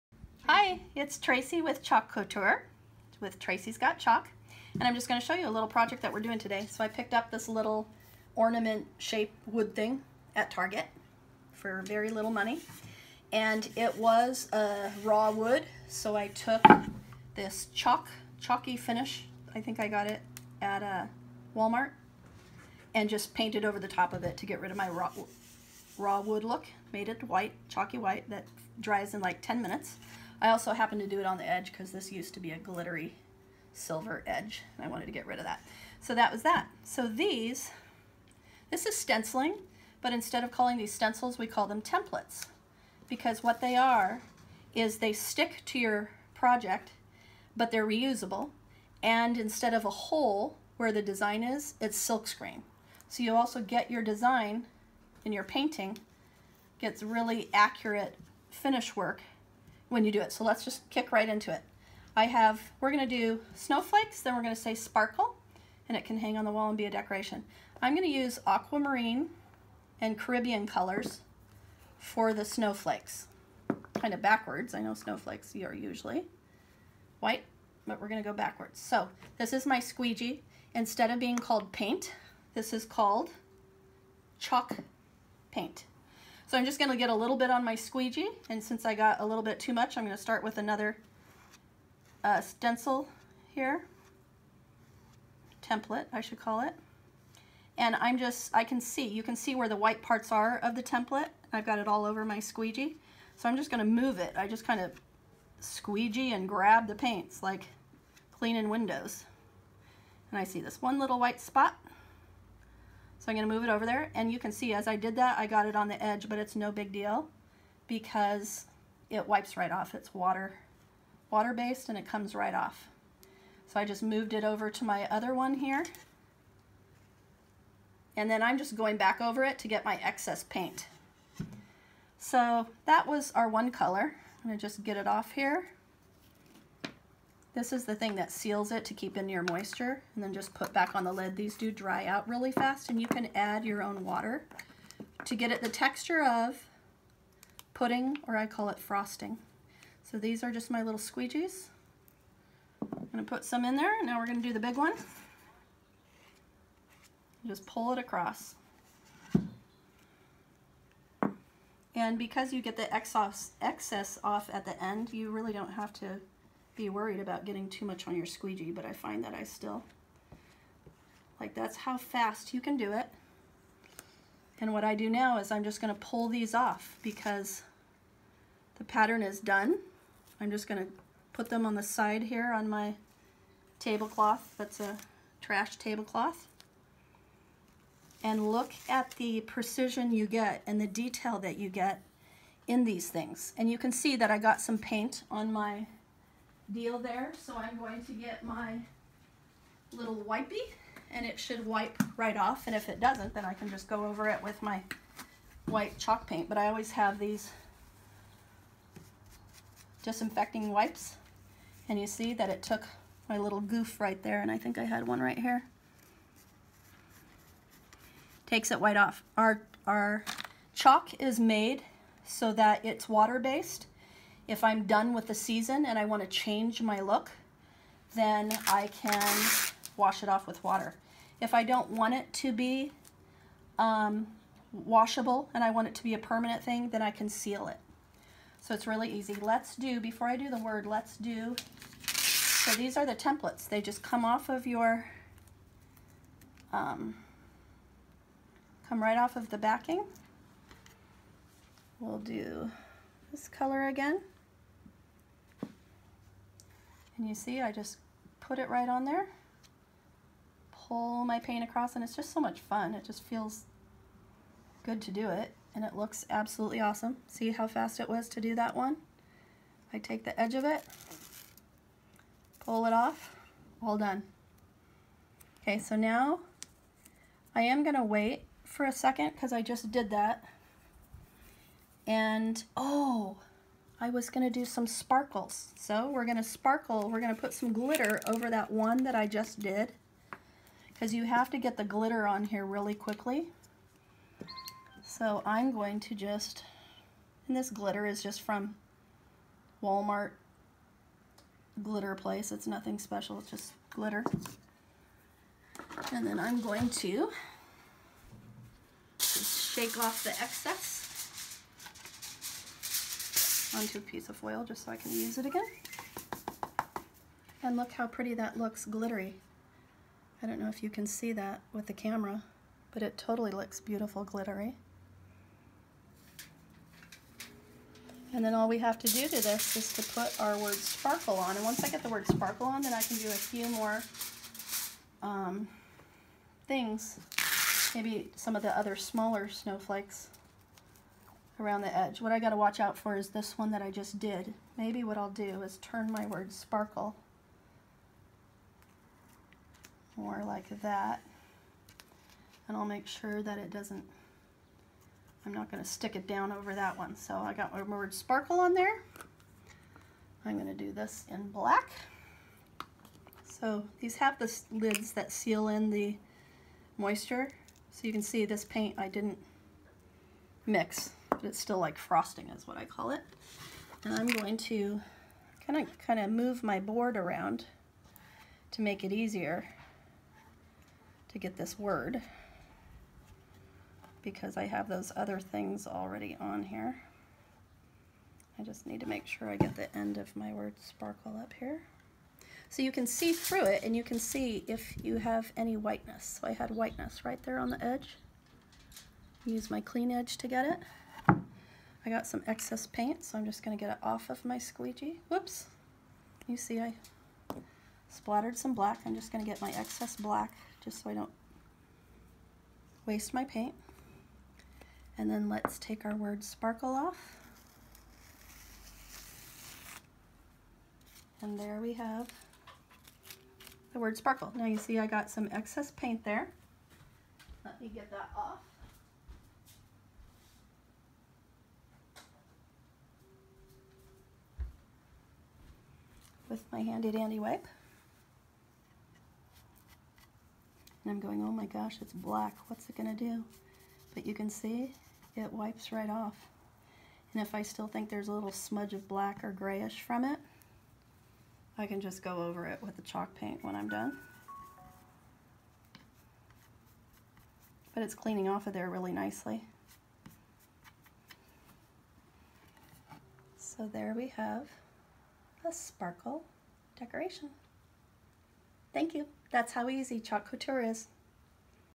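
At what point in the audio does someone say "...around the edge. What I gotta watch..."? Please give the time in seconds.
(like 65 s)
341 s.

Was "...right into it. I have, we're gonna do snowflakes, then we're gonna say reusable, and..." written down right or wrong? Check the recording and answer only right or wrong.
wrong.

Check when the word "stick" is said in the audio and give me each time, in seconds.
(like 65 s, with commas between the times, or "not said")
45 s, 355 s.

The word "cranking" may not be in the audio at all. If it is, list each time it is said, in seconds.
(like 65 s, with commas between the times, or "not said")
not said.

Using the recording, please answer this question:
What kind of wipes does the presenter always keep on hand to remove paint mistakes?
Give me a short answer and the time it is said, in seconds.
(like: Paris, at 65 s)
Disinfecting wipes, at 210 s.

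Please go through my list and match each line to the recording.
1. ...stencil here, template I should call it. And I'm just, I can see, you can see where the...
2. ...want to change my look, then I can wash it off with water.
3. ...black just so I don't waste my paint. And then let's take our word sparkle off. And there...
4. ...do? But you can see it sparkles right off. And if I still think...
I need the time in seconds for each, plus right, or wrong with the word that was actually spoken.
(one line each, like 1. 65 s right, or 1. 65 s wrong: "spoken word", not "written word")
1. 92 s right
2. 226 s right
3. 410 s right
4. 443 s wrong: "wipes", not "sparkles".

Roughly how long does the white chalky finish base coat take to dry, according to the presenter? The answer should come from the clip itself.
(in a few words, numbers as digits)
10 minutes.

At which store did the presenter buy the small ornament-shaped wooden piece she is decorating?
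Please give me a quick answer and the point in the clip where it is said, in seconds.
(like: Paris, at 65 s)
Target, at 10 s.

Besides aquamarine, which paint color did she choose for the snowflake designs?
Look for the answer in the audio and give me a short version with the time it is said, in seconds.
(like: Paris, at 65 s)
Caribbean, at 70 s.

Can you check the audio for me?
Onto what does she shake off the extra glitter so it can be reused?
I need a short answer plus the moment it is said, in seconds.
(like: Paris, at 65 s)
Foil, at 314 s.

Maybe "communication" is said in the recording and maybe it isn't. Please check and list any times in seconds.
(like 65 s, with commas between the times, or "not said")
not said.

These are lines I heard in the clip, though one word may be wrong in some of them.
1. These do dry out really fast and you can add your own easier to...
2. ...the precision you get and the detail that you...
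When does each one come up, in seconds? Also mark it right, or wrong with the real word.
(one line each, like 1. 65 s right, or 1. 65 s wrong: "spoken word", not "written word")
1. 141 s wrong: "water", not "easier"
2. 189 s right.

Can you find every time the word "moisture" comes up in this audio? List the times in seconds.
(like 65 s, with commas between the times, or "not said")
139 s, 366 s.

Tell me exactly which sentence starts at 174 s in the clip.
And what I do now is I'm just gonna pull these off because the pattern is done.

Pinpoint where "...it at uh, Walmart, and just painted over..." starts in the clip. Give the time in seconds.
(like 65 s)
20 s.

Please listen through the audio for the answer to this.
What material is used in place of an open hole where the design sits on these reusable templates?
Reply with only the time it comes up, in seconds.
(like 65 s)
51 s.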